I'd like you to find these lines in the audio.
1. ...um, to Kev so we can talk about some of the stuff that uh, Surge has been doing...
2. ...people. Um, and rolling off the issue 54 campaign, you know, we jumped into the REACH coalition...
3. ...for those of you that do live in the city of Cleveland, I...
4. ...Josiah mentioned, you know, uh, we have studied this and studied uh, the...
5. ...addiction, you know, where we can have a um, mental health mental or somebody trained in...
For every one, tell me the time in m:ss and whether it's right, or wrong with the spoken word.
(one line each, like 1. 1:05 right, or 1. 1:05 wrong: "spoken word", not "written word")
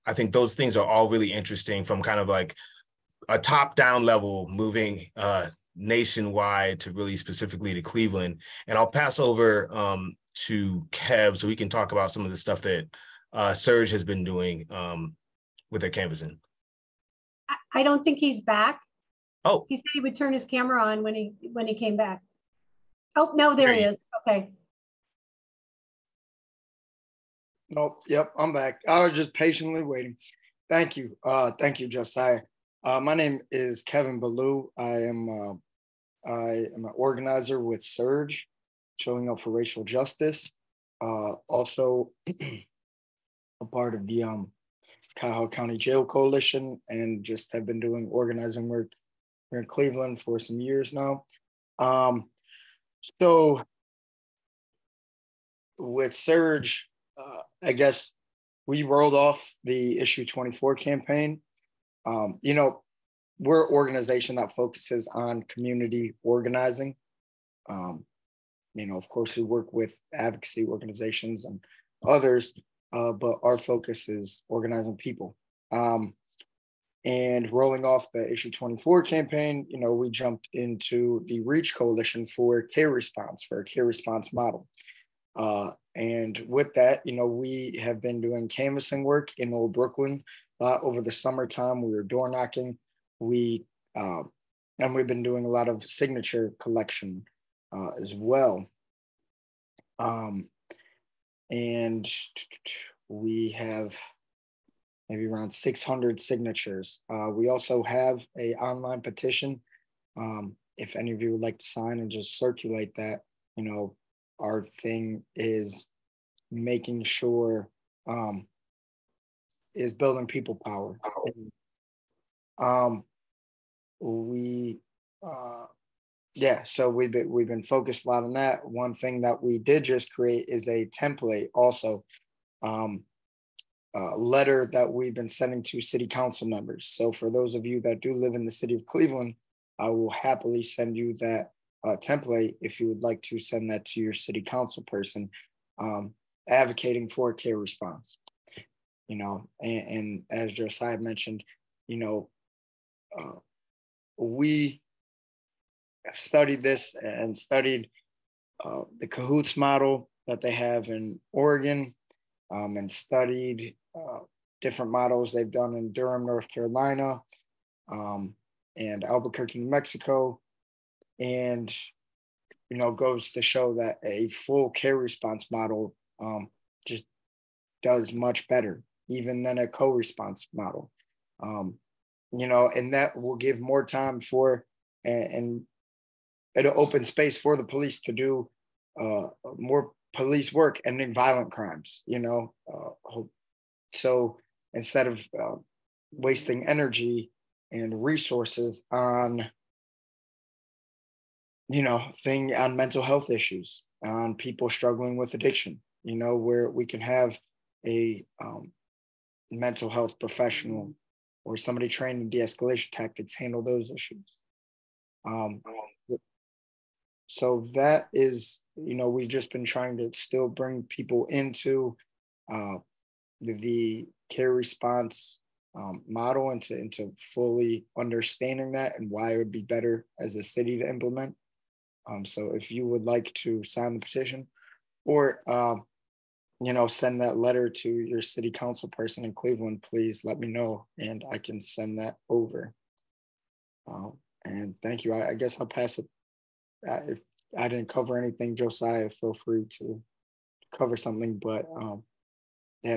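1. 0:09 right
2. 1:14 wrong: "24", not "54"
3. 2:17 right
4. 2:30 right
5. 3:25 wrong: "professional", not "mental".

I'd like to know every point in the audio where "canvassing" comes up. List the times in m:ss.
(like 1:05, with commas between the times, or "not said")
0:15, 1:28.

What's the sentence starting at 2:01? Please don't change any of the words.
And, um, we, uh, yeah, so we've been, we've been focused a lot on that.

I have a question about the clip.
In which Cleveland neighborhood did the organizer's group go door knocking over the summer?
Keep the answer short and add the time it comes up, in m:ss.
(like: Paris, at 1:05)
Old Brooklyn, at 1:29.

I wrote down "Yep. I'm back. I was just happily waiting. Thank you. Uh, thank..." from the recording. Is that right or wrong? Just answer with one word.
wrong.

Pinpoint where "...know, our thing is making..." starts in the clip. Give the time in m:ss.
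1:53.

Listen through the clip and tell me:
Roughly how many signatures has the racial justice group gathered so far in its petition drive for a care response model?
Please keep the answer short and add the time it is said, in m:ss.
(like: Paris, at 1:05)
600, at 1:45.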